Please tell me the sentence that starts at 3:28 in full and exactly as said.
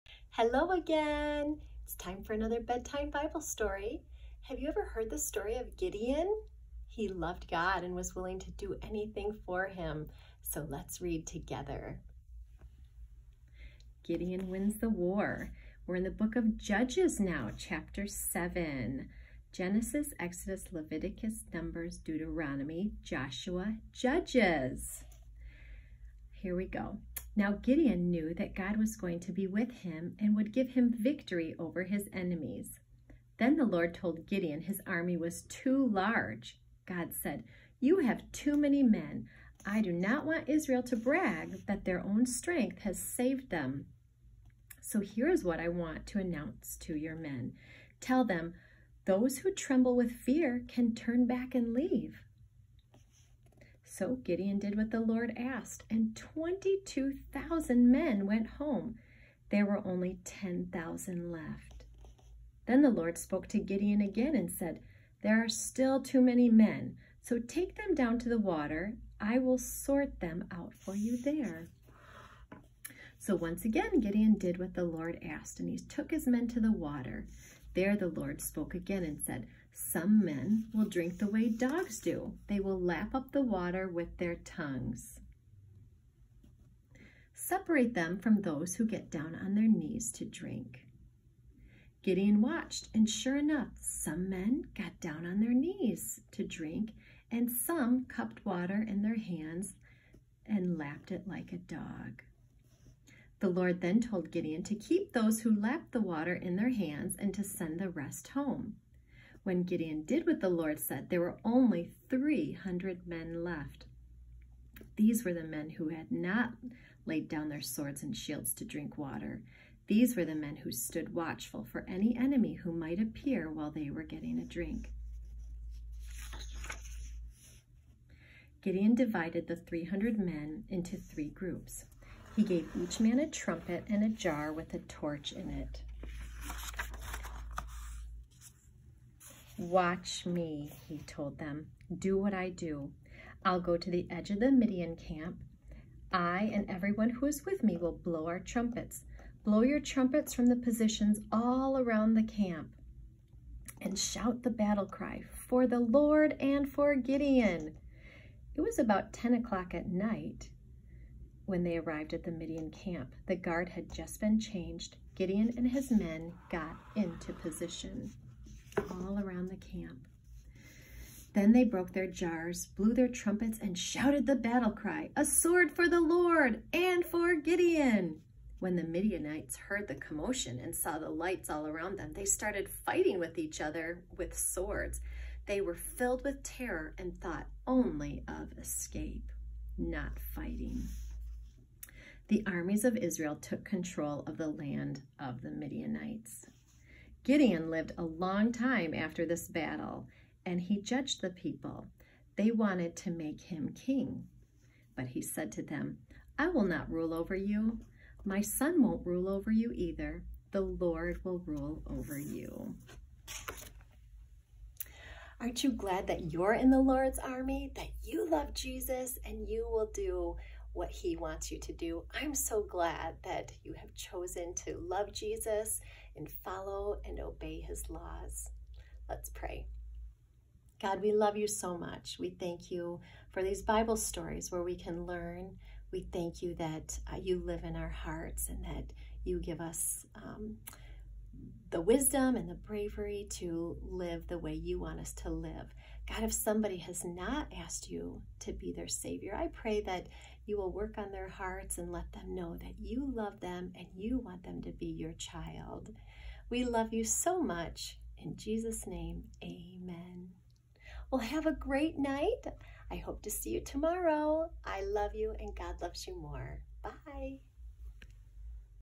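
My son won't rule over you either.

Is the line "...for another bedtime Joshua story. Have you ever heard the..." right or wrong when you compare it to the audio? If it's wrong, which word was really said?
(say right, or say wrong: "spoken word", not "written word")
wrong: "Bible", not "Joshua".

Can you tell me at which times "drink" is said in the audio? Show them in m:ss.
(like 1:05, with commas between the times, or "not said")
1:20, 1:30, 1:36, 1:58, 2:04.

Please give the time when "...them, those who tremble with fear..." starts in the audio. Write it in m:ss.
0:48.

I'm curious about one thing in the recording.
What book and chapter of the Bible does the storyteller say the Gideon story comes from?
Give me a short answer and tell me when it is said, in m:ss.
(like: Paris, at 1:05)
Judges chapter 7, at 0:16.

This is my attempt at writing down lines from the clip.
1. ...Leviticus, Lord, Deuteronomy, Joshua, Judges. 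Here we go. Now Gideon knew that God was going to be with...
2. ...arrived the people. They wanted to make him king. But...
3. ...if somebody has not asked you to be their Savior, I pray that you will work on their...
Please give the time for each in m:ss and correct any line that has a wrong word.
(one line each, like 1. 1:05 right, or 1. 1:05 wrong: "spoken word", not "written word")
1. 0:20 wrong: "Numbers", not "Lord"
2. 3:20 wrong: "judged", not "arrived"
3. 4:06 right.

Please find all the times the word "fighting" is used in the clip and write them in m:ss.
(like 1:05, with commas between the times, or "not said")
3:02, 3:10.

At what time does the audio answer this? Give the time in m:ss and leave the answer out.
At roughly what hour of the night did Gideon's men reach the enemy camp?
2:39.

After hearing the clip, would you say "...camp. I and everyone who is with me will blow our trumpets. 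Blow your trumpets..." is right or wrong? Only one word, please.
right.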